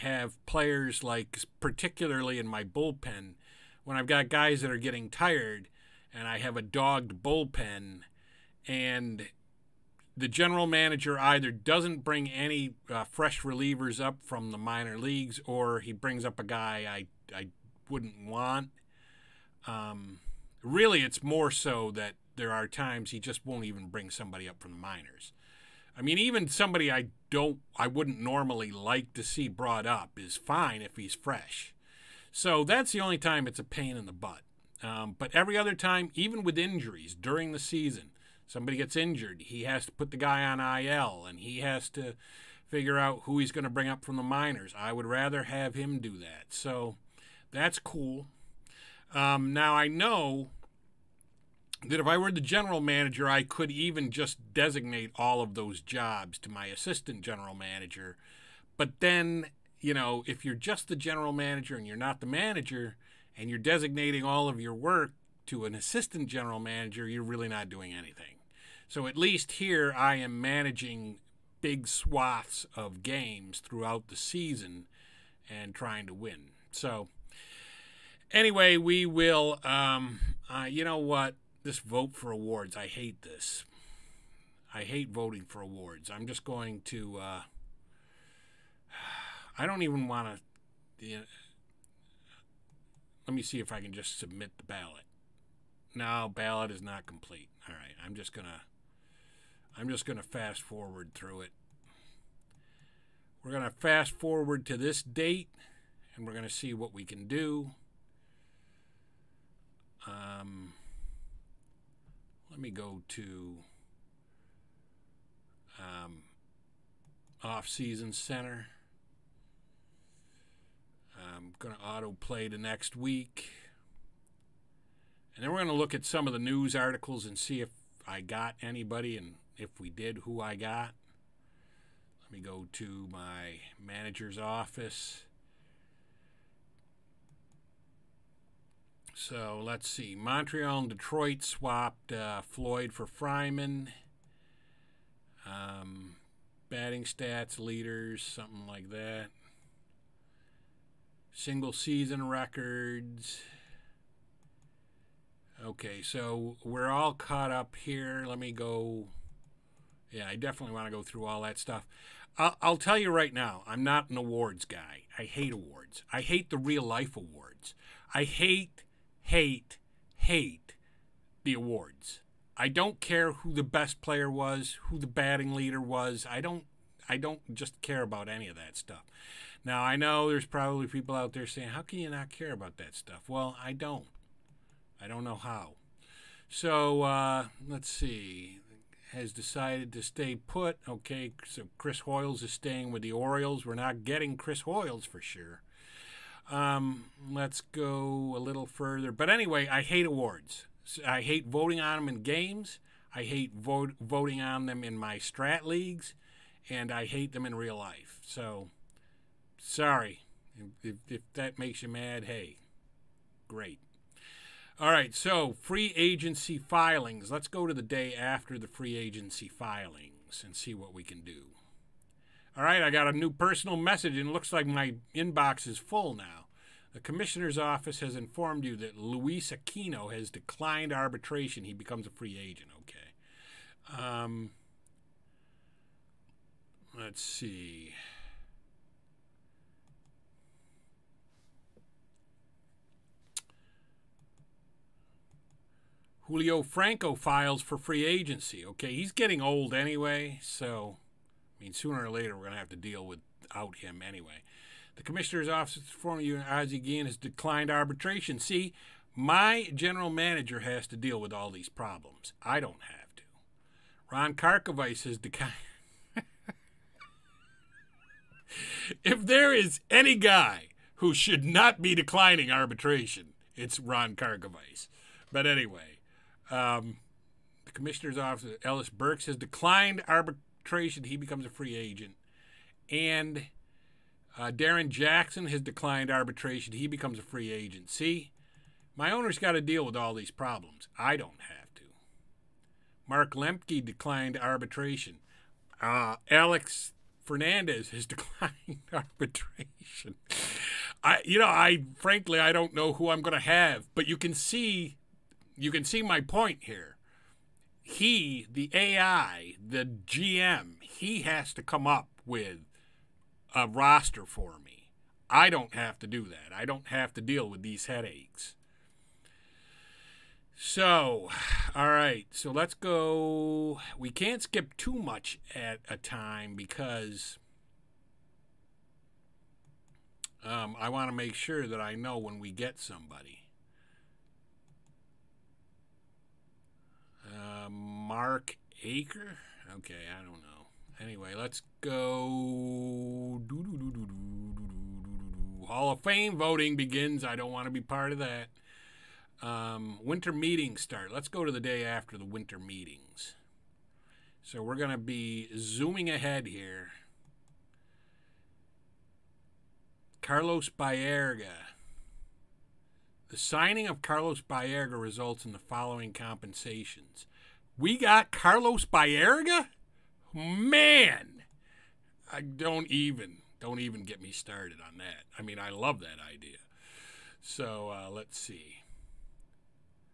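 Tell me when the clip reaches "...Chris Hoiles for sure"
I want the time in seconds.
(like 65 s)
194 s.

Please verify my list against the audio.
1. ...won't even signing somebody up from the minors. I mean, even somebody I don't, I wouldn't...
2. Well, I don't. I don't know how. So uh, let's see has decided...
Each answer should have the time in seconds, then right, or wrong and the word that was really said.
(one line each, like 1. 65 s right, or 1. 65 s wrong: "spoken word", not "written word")
1. 23 s wrong: "bring", not "signing"
2. 183 s right.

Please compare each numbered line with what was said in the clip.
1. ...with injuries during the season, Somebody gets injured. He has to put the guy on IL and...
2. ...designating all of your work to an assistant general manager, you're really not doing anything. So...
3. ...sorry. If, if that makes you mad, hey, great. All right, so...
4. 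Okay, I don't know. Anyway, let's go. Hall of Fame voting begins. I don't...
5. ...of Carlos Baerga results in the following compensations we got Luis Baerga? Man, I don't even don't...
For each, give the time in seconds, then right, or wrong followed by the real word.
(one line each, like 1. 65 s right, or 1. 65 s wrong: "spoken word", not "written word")
1. 36 s right
2. 63 s right
3. 209 s right
4. 339 s right
5. 363 s wrong: "Carlos", not "Luis".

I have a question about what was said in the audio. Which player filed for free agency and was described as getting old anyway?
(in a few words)
Julio Franco.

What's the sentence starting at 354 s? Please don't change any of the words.
So we're going to be zooming ahead here.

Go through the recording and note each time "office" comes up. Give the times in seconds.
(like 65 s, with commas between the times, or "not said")
134 s, 227 s, 255 s, 278 s.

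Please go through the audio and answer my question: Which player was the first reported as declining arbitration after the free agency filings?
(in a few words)
Luis Aquino.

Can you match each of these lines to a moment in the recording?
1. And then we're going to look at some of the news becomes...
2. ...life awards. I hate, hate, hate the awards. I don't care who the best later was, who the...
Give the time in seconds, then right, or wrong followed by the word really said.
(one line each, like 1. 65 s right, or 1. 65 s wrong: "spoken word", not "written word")
1. 125 s wrong: "articles", not "becomes"
2. 166 s wrong: "player", not "later".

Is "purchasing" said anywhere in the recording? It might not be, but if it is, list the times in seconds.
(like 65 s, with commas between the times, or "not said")
not said.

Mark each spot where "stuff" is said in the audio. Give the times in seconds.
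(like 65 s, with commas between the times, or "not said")
161 s, 178 s, 182 s.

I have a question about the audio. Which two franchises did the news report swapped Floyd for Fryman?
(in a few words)
Montreal and Detroit.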